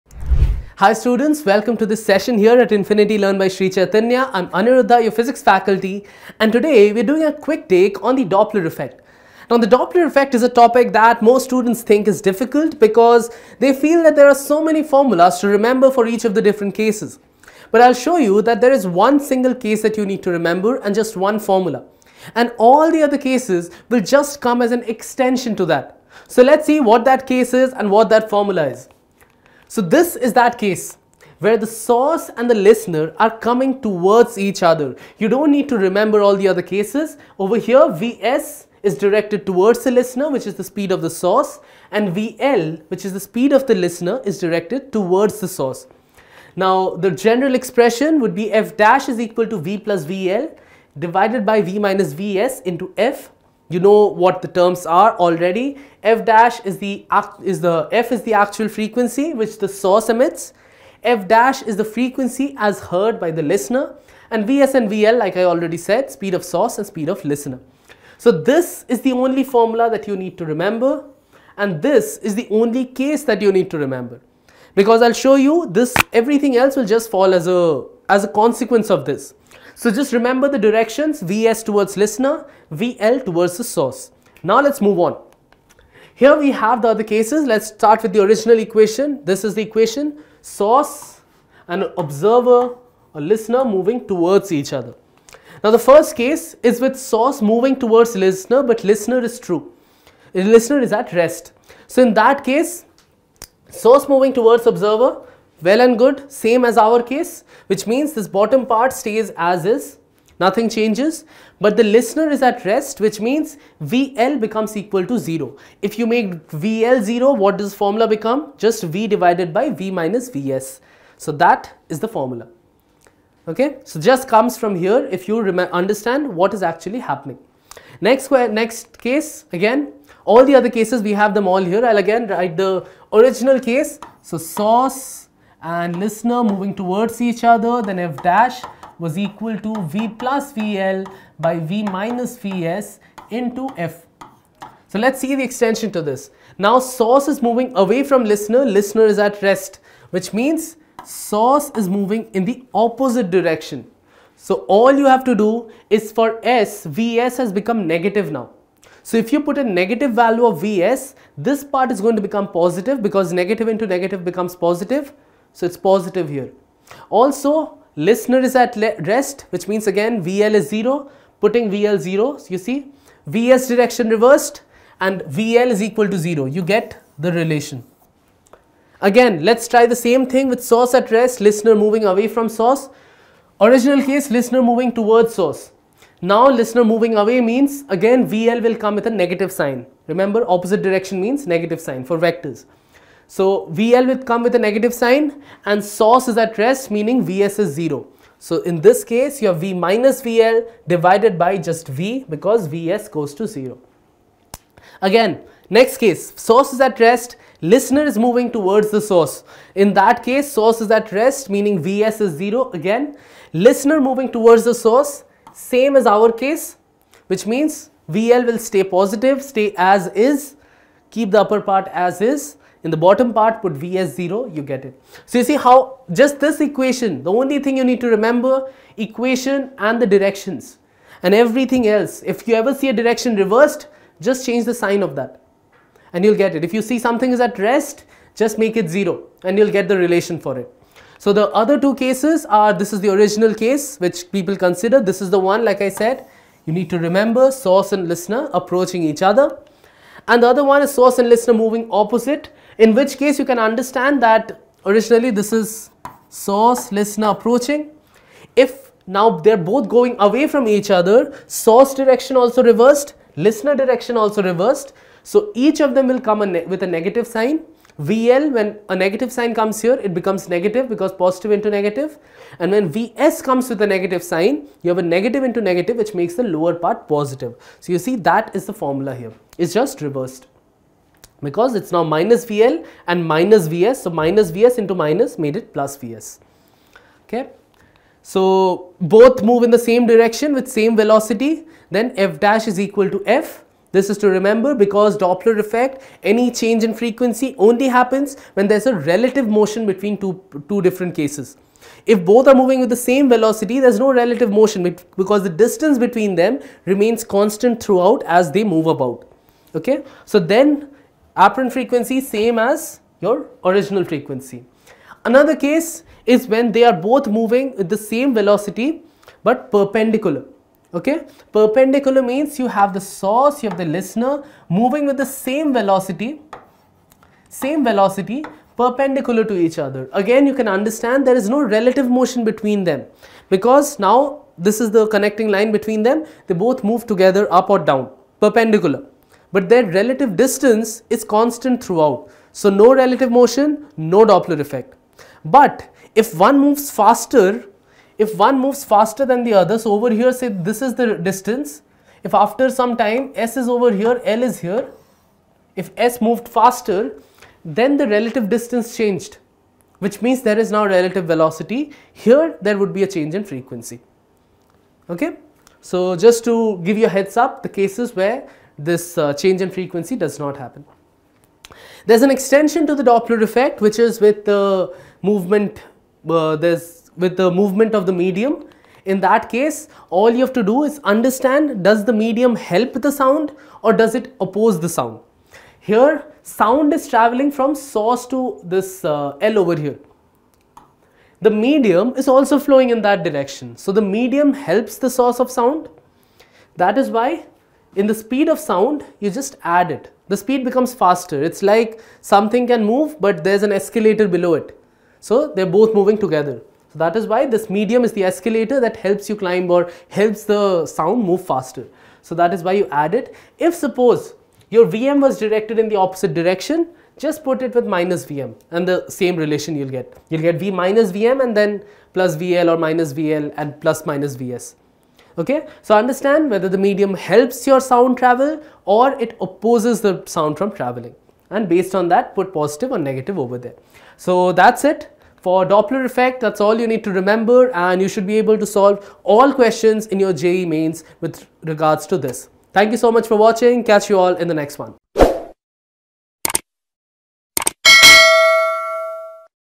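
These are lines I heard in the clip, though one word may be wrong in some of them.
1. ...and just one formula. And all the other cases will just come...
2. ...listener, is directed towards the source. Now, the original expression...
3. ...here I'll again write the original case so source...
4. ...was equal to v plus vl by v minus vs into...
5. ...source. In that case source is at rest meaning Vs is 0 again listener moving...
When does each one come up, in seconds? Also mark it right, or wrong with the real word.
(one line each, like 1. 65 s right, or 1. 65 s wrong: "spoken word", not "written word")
1. 20 s right
2. 43 s wrong: "general", not "original"
3. 131 s right
4. 138 s right
5. 208 s right.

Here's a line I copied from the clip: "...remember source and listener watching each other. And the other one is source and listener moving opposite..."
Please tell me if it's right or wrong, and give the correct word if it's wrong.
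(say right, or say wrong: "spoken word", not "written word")
wrong: "approaching", not "watching".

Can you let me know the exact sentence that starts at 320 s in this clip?
Okay, perpendicular means you have the source, you have the listener moving with the same velocity, same velocity perpendicular to each other.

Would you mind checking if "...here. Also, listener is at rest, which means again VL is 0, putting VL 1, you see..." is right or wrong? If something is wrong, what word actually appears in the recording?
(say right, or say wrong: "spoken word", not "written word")
wrong: "0", not "1".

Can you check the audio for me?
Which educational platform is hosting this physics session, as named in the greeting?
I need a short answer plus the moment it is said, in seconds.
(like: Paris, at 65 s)
Infinity Learn by Sri Chaitanya, at 2 s.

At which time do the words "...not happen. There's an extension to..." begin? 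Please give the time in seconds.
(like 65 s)
370 s.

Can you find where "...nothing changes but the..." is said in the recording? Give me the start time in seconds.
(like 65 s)
110 s.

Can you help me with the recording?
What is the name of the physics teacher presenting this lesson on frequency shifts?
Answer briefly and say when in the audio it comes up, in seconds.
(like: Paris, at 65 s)
Aniruddha, at 4 s.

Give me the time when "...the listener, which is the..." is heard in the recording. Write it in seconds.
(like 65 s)
39 s.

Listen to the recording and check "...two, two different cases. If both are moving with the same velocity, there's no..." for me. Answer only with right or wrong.
right.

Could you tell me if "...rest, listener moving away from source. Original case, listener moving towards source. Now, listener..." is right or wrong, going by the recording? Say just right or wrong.
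right.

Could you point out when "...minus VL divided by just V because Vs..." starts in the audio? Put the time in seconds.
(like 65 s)
199 s.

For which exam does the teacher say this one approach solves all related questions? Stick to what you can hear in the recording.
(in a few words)
JEE mains.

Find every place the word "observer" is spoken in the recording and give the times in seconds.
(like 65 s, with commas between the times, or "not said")
91 s, 104 s.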